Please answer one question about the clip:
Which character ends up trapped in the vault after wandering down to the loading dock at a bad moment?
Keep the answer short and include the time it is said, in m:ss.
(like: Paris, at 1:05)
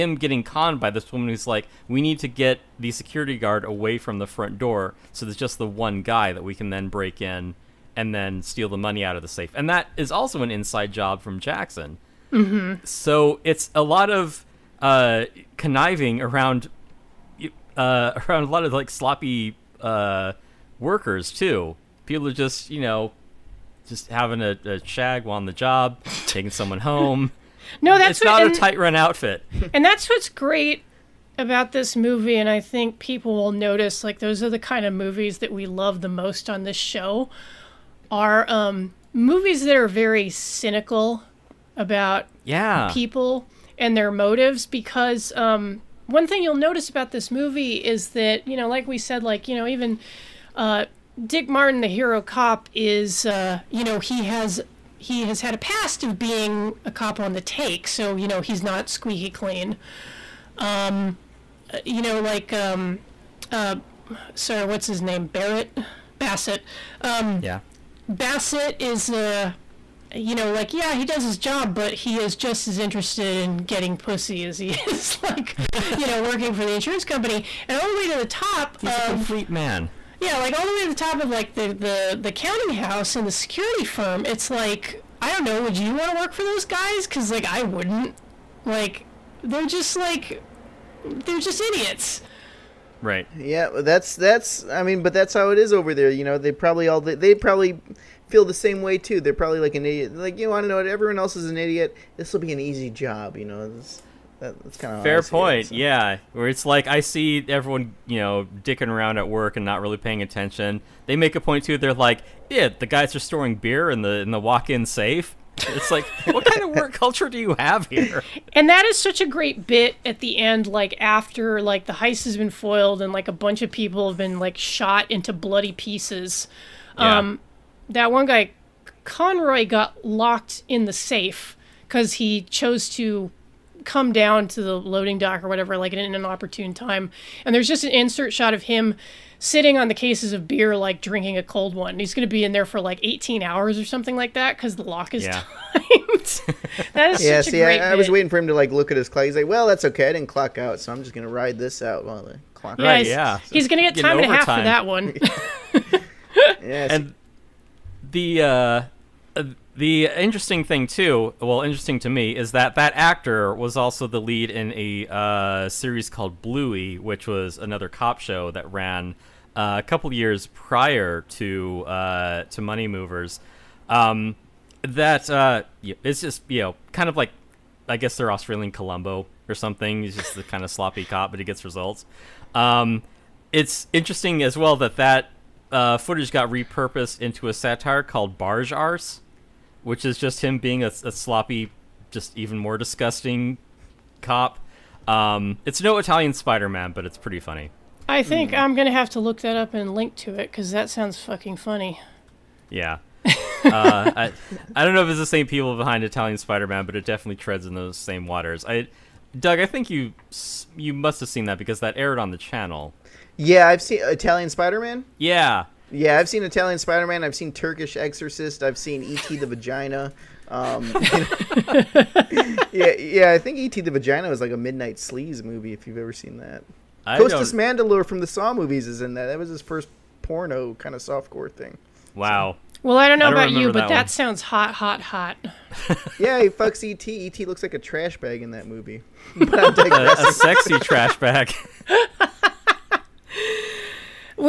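Conroy, at 2:09.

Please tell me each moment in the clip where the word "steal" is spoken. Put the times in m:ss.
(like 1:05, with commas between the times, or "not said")
0:08.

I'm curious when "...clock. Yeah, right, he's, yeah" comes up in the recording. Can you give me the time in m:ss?
2:32.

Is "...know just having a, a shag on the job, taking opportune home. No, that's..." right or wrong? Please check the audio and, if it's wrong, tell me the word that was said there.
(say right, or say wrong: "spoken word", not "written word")
wrong: "someone", not "opportune".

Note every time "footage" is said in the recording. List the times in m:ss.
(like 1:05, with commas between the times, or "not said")
3:05.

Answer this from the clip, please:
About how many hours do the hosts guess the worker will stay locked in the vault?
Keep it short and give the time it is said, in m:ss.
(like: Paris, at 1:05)
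18, at 2:23.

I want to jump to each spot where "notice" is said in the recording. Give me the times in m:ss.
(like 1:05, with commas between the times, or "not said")
0:33, 0:46.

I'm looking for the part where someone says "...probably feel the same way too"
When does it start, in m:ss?
1:37.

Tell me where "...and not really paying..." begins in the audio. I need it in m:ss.
1:49.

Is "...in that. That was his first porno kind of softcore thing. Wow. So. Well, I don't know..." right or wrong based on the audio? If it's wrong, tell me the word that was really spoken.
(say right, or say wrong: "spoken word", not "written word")
right.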